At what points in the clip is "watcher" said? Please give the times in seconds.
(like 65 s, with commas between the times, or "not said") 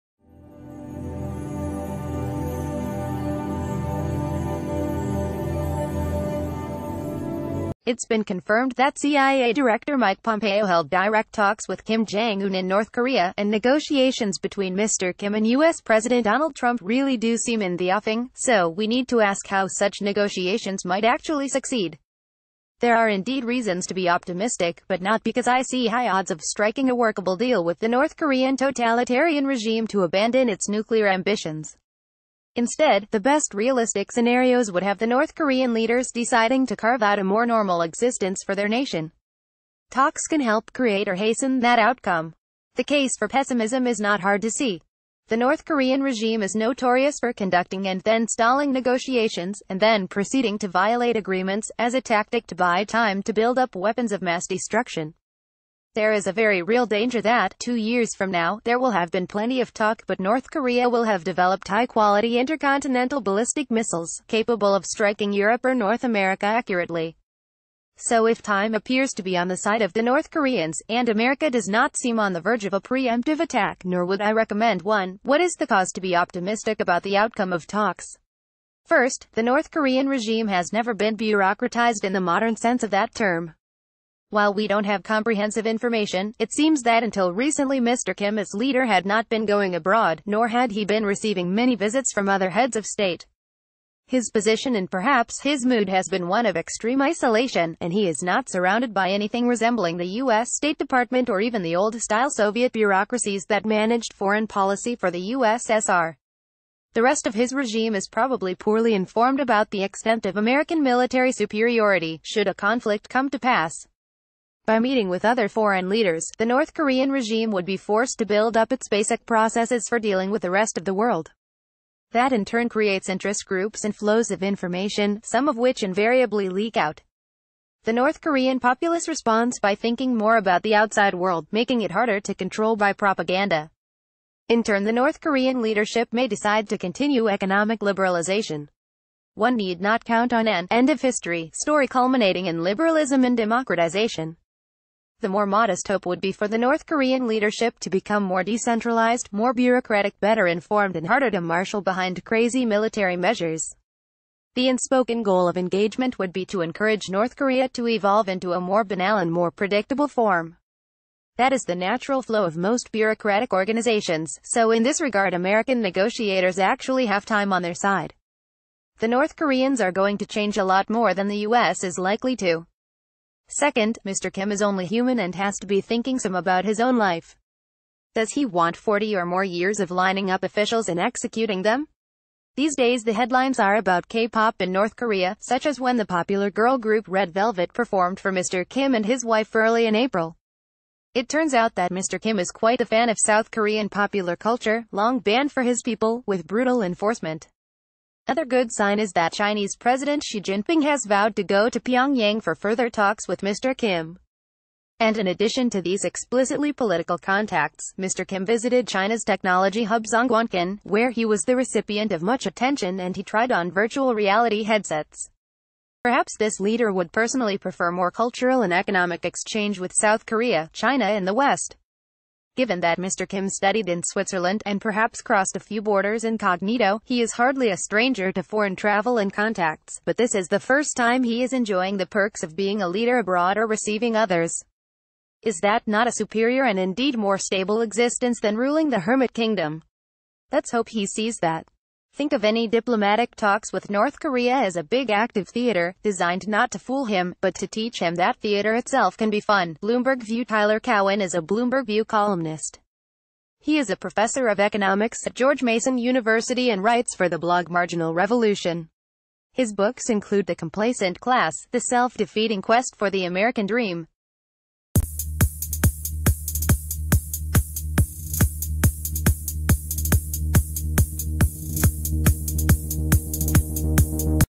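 not said.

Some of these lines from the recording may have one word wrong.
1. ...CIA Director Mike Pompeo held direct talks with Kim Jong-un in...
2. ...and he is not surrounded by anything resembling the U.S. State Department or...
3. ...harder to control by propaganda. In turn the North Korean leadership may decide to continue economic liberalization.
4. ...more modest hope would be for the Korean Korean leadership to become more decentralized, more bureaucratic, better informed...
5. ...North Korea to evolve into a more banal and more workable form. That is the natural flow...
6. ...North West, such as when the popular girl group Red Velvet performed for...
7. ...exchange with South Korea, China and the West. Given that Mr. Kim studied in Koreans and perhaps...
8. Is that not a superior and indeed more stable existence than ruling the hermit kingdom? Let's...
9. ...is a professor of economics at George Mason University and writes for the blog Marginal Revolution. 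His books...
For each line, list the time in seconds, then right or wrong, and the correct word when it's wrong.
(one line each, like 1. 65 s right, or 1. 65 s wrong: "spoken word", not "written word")
1. 8 s right
2. 97 s right
3. 131 s right
4. 145 s wrong: "North", not "Korean"
5. 157 s wrong: "predictable", not "workable"
6. 184 s wrong: "Korea", not "West"
7. 219 s wrong: "Switzerland", not "Koreans"
8. 235 s right
9. 253 s right.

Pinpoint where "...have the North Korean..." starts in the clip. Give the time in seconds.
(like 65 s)
34 s.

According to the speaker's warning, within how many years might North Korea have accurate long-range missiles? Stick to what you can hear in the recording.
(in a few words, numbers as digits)
2.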